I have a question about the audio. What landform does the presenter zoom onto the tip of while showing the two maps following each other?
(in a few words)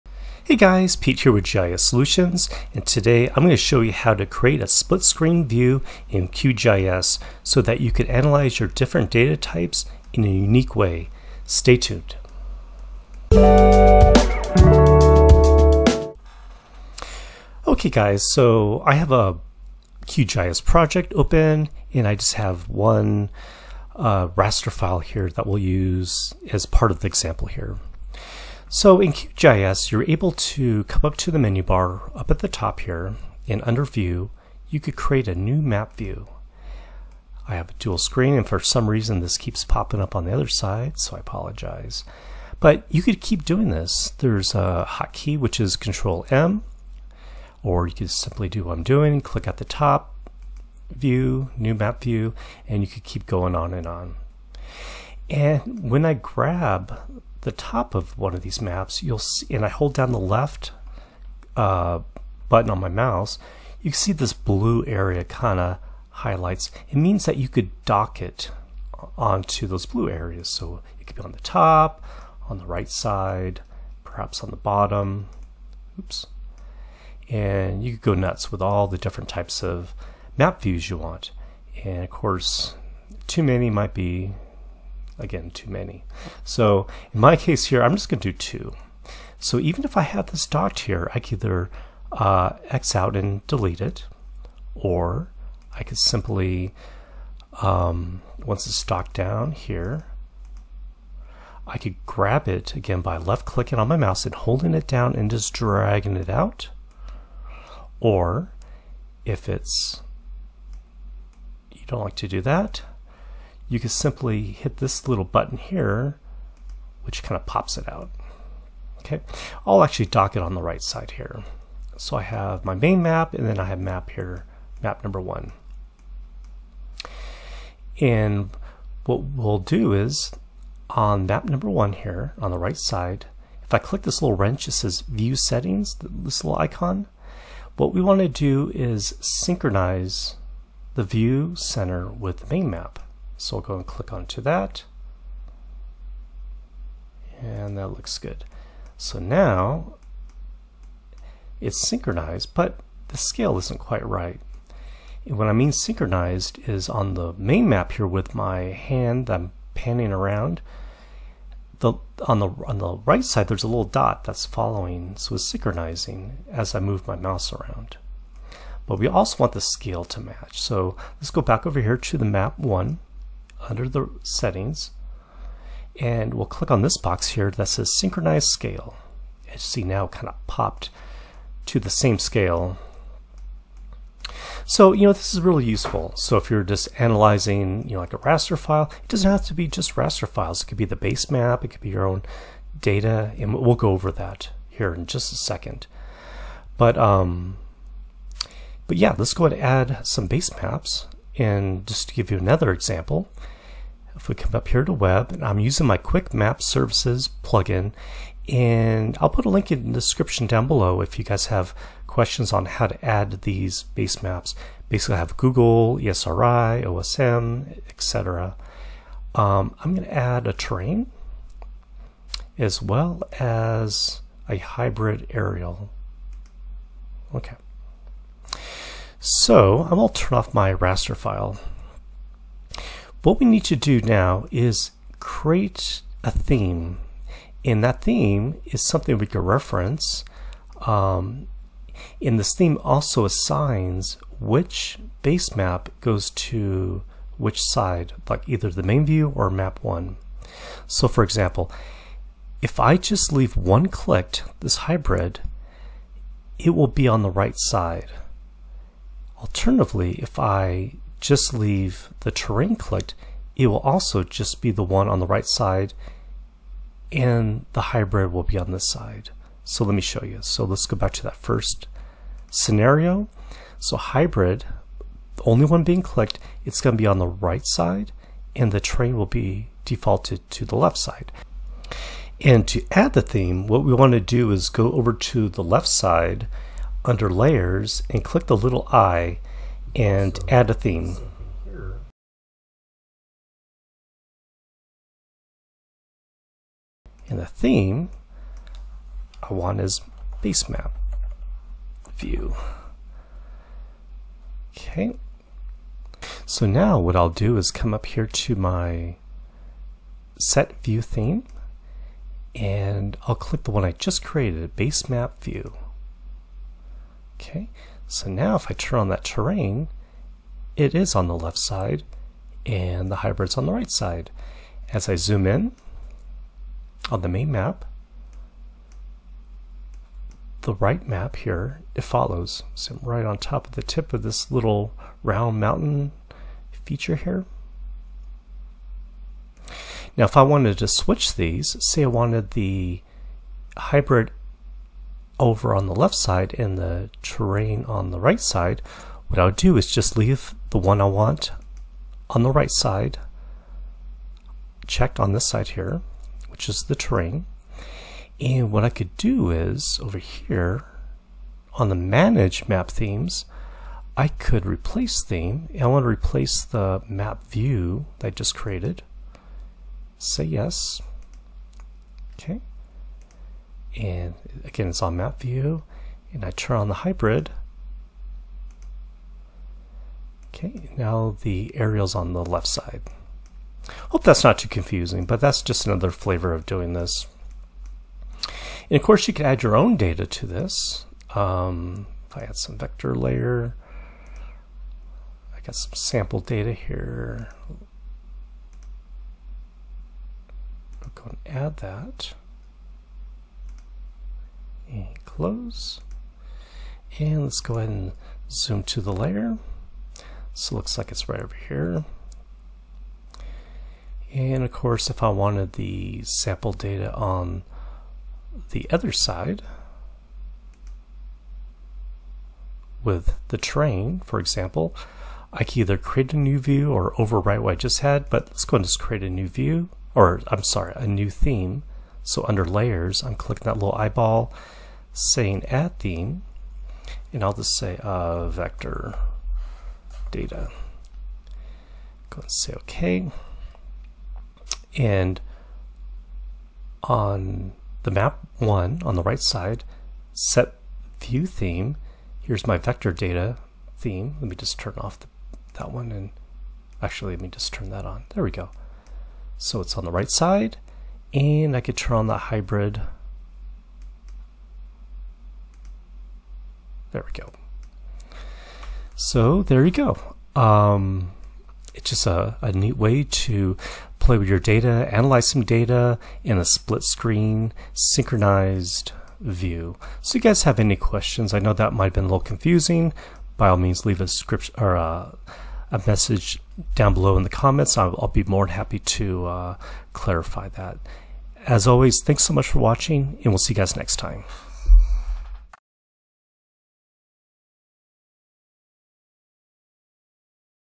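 round mountain.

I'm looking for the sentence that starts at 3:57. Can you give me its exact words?
And that theme is something we can reference.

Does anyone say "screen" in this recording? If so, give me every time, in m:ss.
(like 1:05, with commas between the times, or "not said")
0:05, 0:37, 7:57.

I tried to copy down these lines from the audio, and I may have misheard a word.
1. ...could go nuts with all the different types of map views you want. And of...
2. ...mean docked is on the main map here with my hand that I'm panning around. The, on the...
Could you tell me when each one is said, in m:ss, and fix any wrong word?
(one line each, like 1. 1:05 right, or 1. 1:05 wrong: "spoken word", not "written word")
1. 1:17 right
2. 2:35 wrong: "synchronized", not "docked".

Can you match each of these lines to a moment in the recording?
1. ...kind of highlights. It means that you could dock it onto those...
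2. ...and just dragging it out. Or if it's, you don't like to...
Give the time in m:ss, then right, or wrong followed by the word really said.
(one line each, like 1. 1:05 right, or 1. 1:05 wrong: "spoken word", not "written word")
1. 1:05 right
2. 1:45 right.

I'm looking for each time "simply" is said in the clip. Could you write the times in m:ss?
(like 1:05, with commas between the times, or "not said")
0:48, 1:35, 1:53.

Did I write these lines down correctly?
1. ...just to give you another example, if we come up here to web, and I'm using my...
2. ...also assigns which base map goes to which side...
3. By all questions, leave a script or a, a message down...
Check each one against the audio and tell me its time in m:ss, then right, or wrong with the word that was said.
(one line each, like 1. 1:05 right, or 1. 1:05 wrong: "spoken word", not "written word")
1. 3:21 right
2. 4:02 right
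3. 8:03 wrong: "means", not "questions".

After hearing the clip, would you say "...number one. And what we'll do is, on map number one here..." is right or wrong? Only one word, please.
right.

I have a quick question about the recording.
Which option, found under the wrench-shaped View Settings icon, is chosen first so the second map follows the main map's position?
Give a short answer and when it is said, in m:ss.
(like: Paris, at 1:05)
synchronize the view center, at 2:19.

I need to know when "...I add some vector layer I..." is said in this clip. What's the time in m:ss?
6:32.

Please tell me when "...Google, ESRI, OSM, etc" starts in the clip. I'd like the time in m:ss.
3:35.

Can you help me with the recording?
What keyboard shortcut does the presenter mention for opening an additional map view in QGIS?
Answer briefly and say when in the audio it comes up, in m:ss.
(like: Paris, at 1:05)
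Control M, at 0:45.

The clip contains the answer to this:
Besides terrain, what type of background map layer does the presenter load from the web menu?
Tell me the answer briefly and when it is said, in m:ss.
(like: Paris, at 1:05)
hybrid aerial, at 3:44.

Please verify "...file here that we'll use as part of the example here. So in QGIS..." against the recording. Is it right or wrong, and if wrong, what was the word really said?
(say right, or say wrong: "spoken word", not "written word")
right.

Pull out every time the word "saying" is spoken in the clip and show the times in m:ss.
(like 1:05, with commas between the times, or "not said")
7:15.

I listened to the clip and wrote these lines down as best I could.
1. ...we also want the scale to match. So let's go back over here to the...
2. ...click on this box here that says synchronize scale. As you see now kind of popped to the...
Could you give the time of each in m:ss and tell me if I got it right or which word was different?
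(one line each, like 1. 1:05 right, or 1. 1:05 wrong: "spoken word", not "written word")
1. 2:48 right
2. 2:56 right.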